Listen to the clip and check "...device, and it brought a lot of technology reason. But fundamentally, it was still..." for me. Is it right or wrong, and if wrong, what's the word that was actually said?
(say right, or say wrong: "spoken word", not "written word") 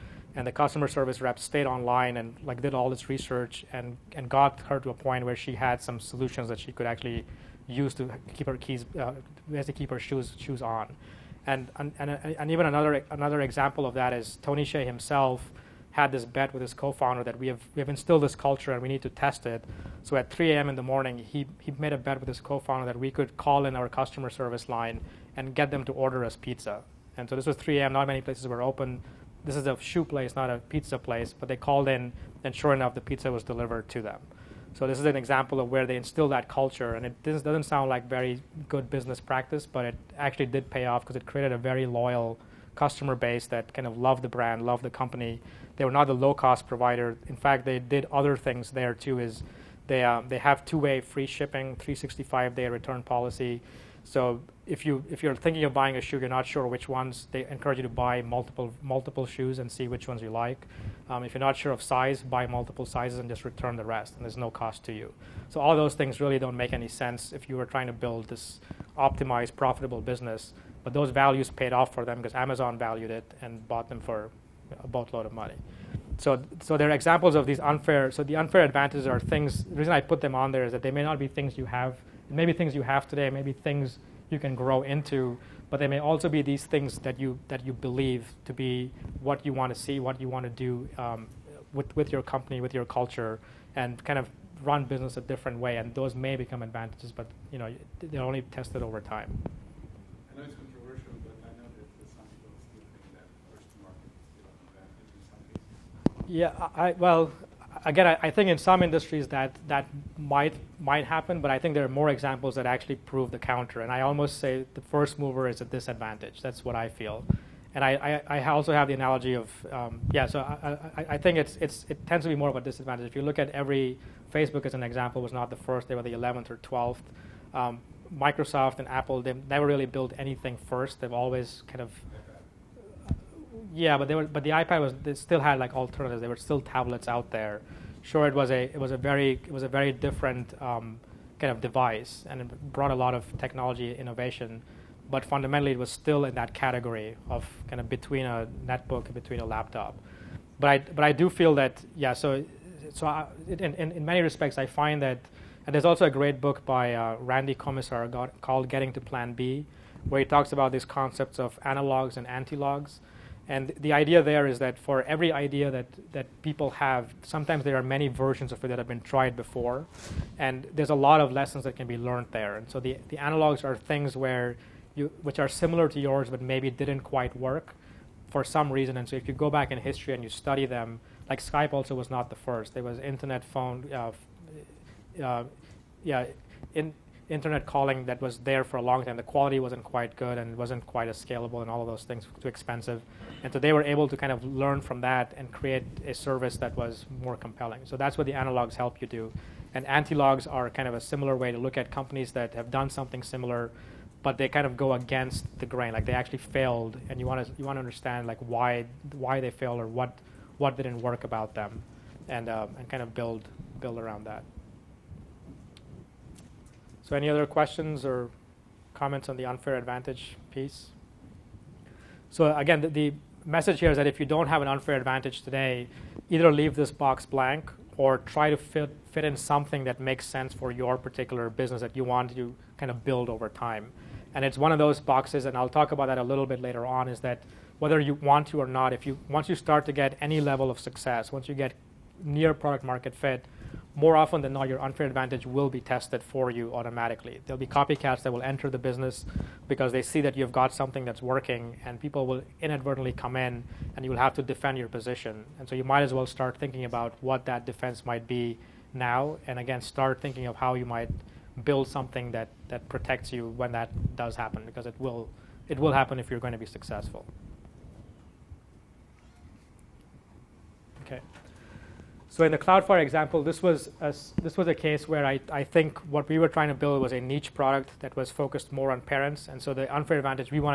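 wrong: "innovation", not "reason".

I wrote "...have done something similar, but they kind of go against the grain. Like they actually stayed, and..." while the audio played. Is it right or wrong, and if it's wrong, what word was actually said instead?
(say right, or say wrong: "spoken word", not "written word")
wrong: "failed", not "stayed".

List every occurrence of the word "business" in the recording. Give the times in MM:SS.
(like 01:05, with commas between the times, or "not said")
00:38, 01:09, 01:34, 03:51, 04:08.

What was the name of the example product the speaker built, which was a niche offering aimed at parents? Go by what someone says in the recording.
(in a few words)
CloudFire.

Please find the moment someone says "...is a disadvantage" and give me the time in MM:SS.
01:55.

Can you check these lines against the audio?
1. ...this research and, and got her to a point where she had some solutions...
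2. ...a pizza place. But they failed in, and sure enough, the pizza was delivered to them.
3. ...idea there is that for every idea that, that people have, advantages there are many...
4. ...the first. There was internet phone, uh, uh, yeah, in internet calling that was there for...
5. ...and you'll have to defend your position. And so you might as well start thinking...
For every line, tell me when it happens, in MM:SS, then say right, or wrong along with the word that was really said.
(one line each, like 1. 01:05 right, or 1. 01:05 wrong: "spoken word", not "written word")
1. 00:02 right
2. 00:30 wrong: "called", not "failed"
3. 02:43 wrong: "sometimes", not "advantages"
4. 03:02 right
5. 04:13 right.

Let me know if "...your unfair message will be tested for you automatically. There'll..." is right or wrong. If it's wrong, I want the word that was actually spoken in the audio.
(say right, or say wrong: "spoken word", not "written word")
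wrong: "advantage", not "message".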